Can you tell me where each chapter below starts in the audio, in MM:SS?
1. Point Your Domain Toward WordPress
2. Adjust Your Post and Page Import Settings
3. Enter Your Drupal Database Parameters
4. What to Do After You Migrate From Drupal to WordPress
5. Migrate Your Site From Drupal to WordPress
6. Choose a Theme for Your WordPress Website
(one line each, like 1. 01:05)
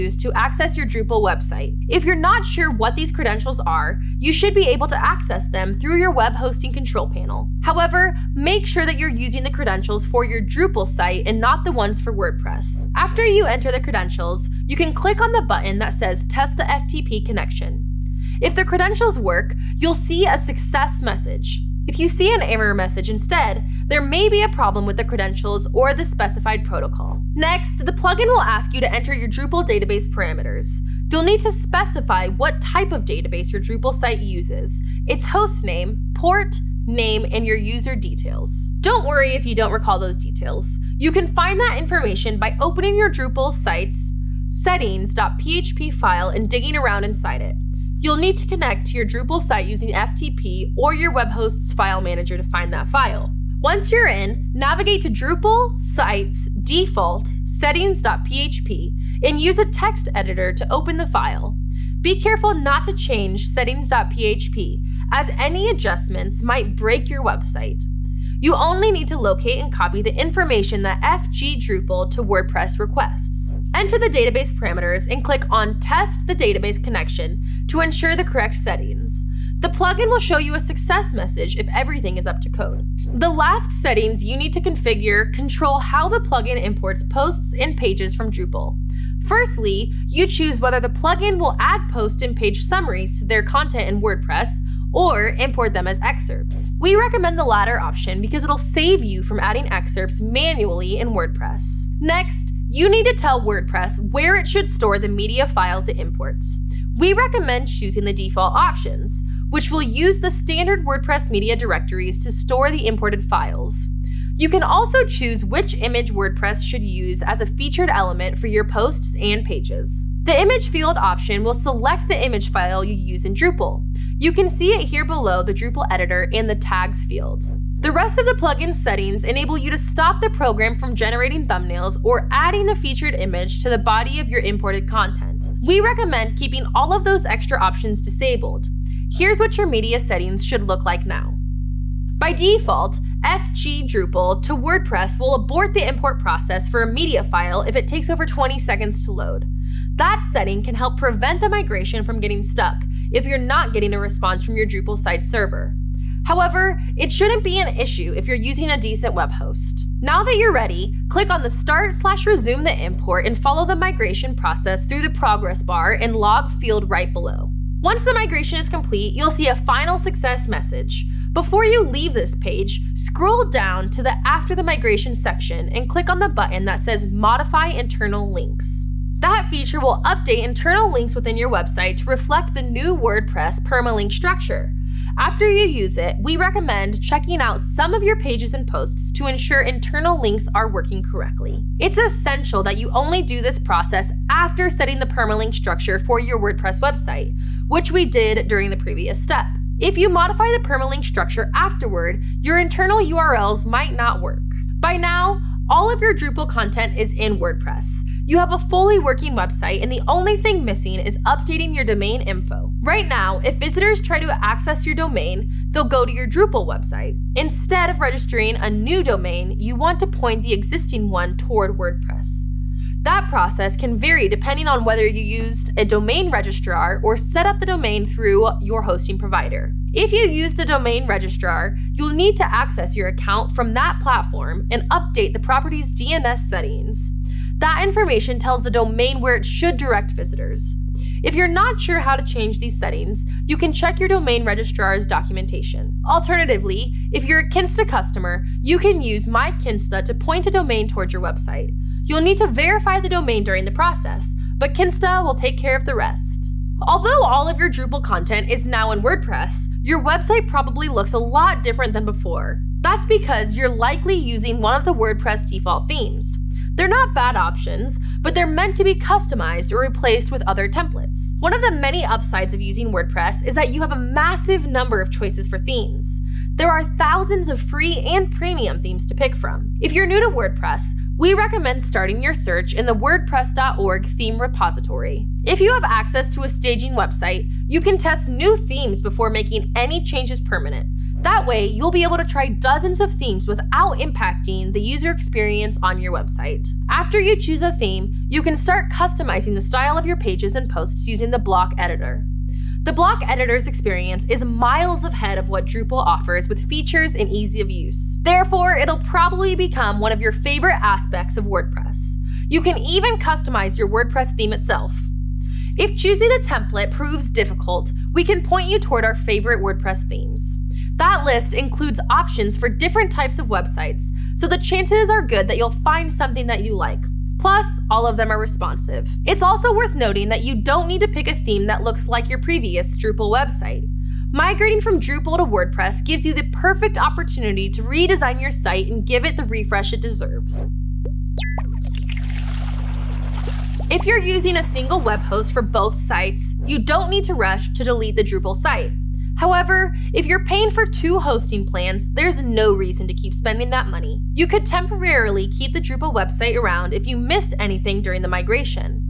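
1. 03:25
2. 01:23
3. 00:28
4. 05:42
5. 02:43
6. 04:17.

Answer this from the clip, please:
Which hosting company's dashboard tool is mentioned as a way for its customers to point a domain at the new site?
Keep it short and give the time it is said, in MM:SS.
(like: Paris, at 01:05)
My Kinsta, at 04:09.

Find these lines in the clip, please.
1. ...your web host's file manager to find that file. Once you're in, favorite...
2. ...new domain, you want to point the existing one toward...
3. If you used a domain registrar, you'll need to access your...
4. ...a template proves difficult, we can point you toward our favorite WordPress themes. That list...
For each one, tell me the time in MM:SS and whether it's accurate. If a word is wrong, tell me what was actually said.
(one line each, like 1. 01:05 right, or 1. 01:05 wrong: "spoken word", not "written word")
1. 00:50 wrong: "navigate", not "favorite"
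2. 03:38 right
3. 03:49 right
4. 05:16 right.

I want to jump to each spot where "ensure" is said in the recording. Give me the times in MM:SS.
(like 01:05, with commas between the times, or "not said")
01:17, 03:09.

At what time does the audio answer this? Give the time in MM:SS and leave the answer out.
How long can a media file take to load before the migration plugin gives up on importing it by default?
02:28.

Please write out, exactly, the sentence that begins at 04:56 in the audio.
After you choose a theme, you can start customizing the style of your pages and posts using the block editor.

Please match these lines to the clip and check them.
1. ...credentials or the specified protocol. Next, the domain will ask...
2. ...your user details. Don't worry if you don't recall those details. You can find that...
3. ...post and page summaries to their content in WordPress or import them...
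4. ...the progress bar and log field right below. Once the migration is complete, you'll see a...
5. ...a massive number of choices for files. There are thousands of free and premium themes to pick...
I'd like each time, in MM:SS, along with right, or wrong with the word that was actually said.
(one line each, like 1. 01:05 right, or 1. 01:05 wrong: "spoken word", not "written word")
1. 00:25 wrong: "plugin", not "domain"
2. 00:37 right
3. 01:31 right
4. 02:45 right
5. 04:33 wrong: "themes", not "files".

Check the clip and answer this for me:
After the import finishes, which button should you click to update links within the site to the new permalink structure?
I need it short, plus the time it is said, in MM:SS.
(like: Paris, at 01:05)
Modify Internal Links, at 02:57.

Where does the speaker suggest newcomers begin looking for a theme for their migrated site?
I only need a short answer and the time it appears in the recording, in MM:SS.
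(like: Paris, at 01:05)
WordPress.org theme repository, at 04:42.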